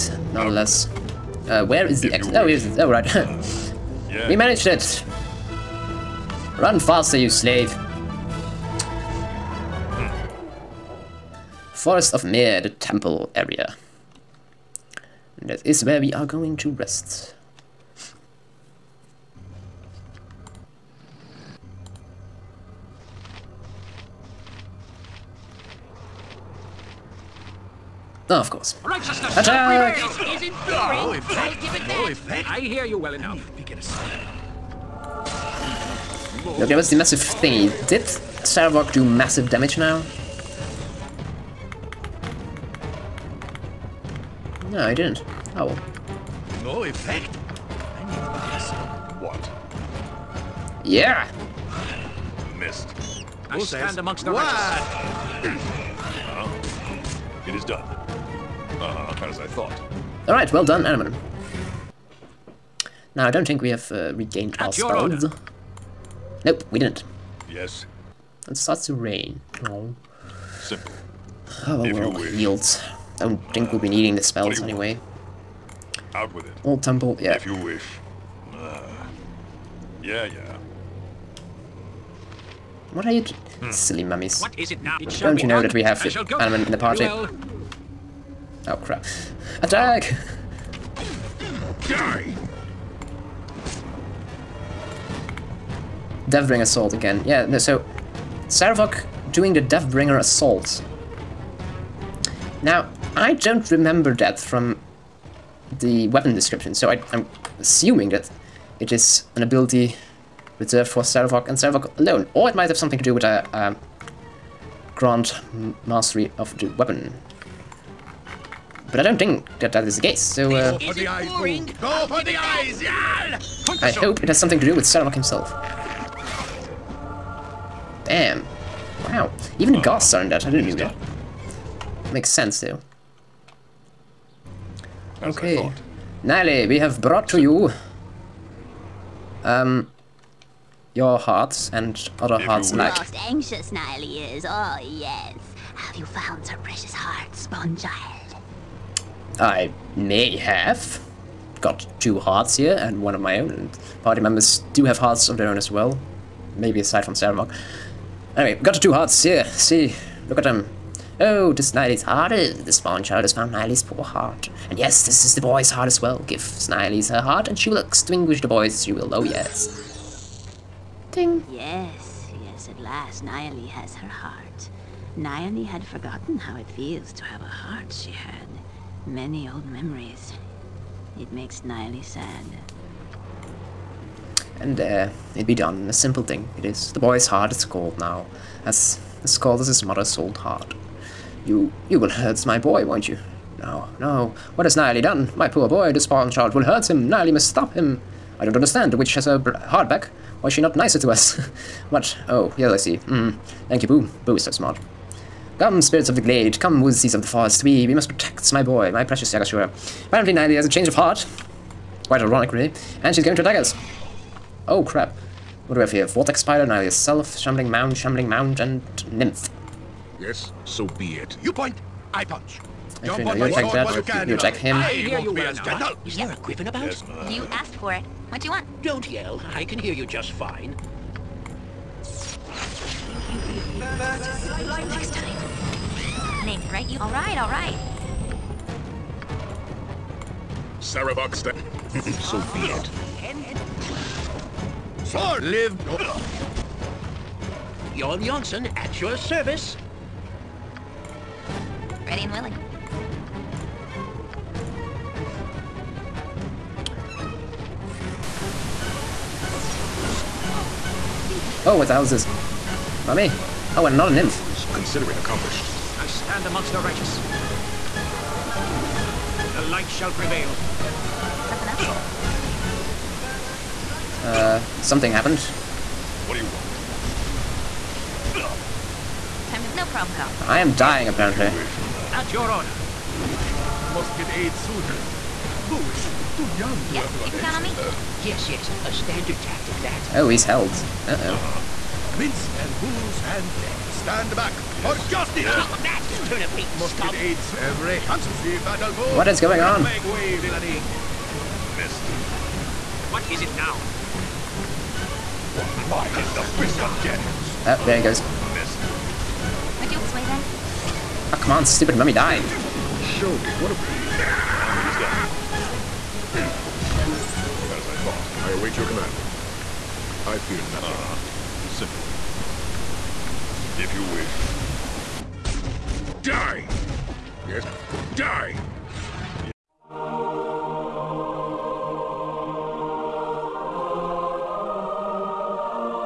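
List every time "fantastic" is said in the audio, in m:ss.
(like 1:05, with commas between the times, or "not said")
not said.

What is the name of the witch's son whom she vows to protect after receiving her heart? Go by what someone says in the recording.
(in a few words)
Yaga-Shura.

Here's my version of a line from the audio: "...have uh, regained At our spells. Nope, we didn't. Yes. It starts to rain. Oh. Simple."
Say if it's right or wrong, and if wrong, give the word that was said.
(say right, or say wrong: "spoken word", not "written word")
right.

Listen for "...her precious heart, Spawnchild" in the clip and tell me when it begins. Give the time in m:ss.
2:26.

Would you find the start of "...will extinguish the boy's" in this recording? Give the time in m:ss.
2:47.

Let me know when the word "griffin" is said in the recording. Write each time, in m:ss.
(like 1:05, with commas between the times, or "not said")
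3:46.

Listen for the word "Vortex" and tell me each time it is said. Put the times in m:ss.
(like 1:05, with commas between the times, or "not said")
3:36.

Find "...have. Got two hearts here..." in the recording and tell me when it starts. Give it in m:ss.
2:30.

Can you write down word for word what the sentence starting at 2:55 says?
Nyalee had forgotten how it feels to have a heart, she had.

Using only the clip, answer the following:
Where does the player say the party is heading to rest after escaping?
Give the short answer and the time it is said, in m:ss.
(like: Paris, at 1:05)
Forest of Mir, at 0:11.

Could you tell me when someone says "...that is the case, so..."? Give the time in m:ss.
1:59.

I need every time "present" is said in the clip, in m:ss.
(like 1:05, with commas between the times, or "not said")
not said.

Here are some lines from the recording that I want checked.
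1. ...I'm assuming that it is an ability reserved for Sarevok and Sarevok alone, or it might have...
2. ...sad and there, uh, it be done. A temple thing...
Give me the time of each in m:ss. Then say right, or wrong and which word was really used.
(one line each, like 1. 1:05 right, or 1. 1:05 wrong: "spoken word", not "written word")
1. 1:47 right
2. 3:02 wrong: "simple", not "temple".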